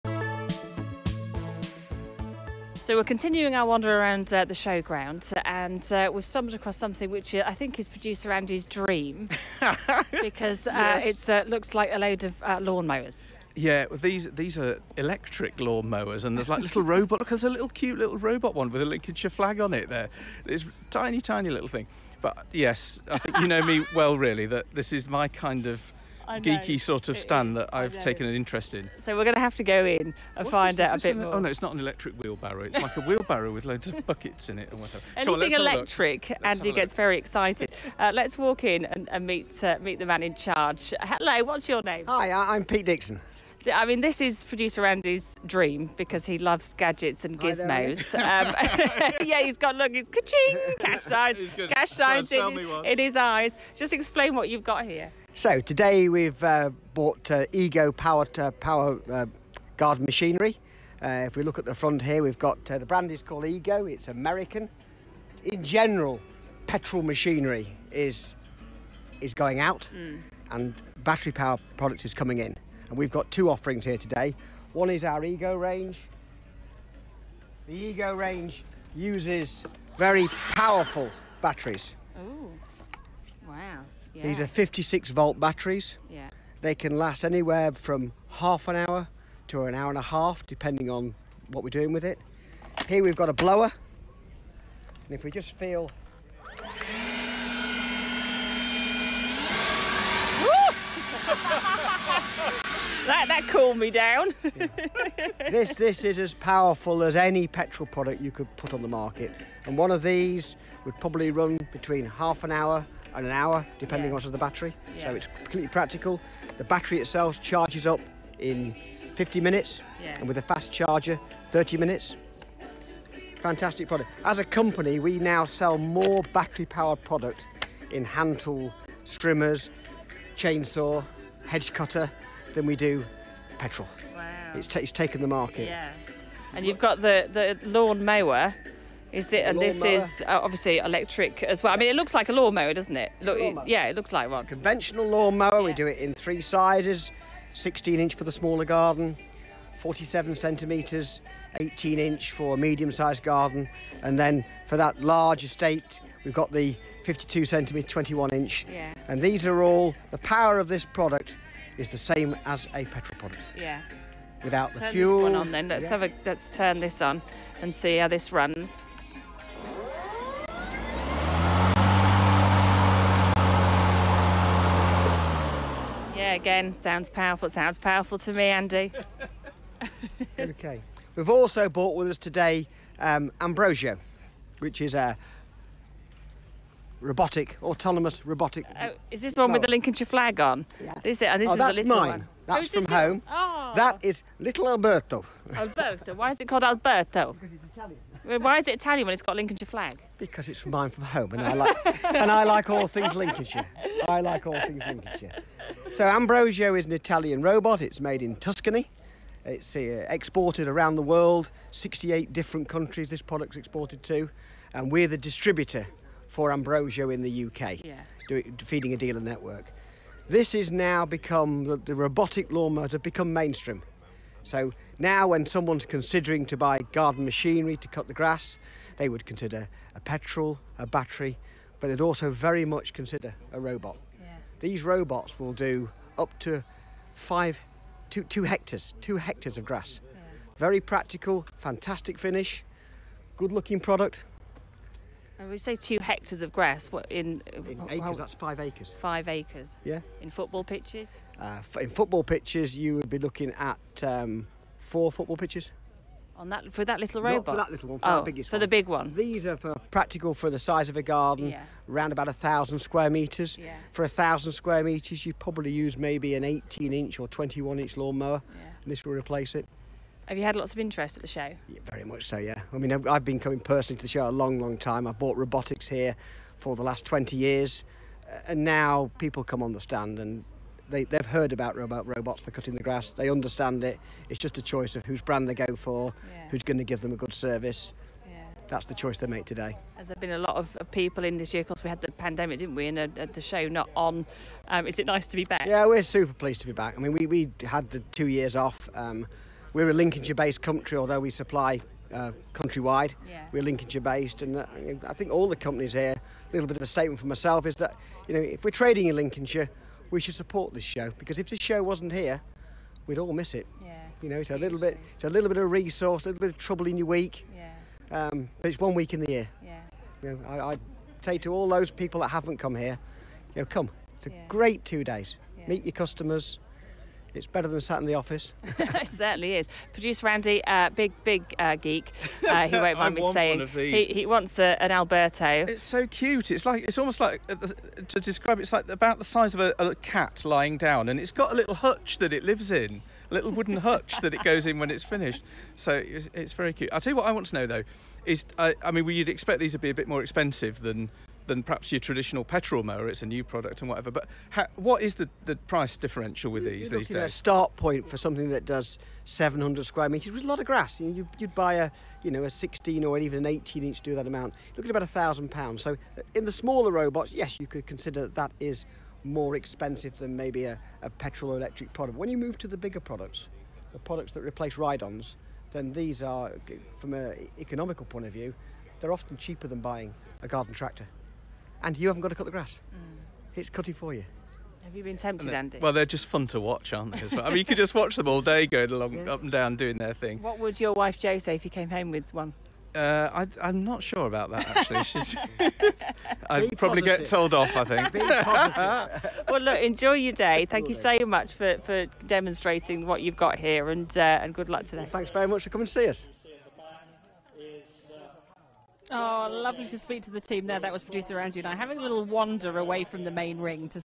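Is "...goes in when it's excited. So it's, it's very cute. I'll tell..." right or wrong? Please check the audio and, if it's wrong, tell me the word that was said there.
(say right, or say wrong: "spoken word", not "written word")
wrong: "finished", not "excited".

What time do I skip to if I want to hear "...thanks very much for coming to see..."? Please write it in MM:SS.
06:45.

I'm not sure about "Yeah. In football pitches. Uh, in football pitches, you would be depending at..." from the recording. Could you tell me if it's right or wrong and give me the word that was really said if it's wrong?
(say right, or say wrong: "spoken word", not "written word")
wrong: "looking", not "depending".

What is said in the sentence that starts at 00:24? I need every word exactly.
That this is my kind of geeky sort of stand that I've taken an interest in.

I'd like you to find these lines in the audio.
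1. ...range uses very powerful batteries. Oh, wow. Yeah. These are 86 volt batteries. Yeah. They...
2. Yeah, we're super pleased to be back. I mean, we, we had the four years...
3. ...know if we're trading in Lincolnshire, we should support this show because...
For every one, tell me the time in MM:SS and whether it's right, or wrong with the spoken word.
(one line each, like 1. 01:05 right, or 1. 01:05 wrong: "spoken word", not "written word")
1. 01:18 wrong: "56", not "86"
2. 04:55 wrong: "two", not "four"
3. 05:08 right.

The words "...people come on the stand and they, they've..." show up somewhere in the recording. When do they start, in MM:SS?
04:39.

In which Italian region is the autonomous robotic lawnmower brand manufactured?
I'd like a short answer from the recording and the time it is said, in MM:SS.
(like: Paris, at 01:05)
Tuscany, at 03:28.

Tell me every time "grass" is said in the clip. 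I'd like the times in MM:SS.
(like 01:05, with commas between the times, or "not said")
03:48, 03:59, 04:06, 04:42, 06:00, 06:22.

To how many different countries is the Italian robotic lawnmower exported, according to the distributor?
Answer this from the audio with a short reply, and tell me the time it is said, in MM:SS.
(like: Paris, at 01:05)
68, at 03:31.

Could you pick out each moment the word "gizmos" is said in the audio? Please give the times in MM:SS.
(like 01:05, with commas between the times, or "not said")
00:47.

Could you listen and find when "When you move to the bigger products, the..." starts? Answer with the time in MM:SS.
06:12.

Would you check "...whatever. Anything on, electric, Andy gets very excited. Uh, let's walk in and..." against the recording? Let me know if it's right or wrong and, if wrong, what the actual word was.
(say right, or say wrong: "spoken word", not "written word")
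right.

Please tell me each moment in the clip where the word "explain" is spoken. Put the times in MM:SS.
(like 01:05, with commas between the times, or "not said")
00:53.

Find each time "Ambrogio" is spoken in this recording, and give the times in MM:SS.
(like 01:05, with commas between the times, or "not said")
03:03, 03:26, 03:36.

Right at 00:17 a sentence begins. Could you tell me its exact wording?
Look, there's a little cute little robot one with a Lincolnshire flag on it.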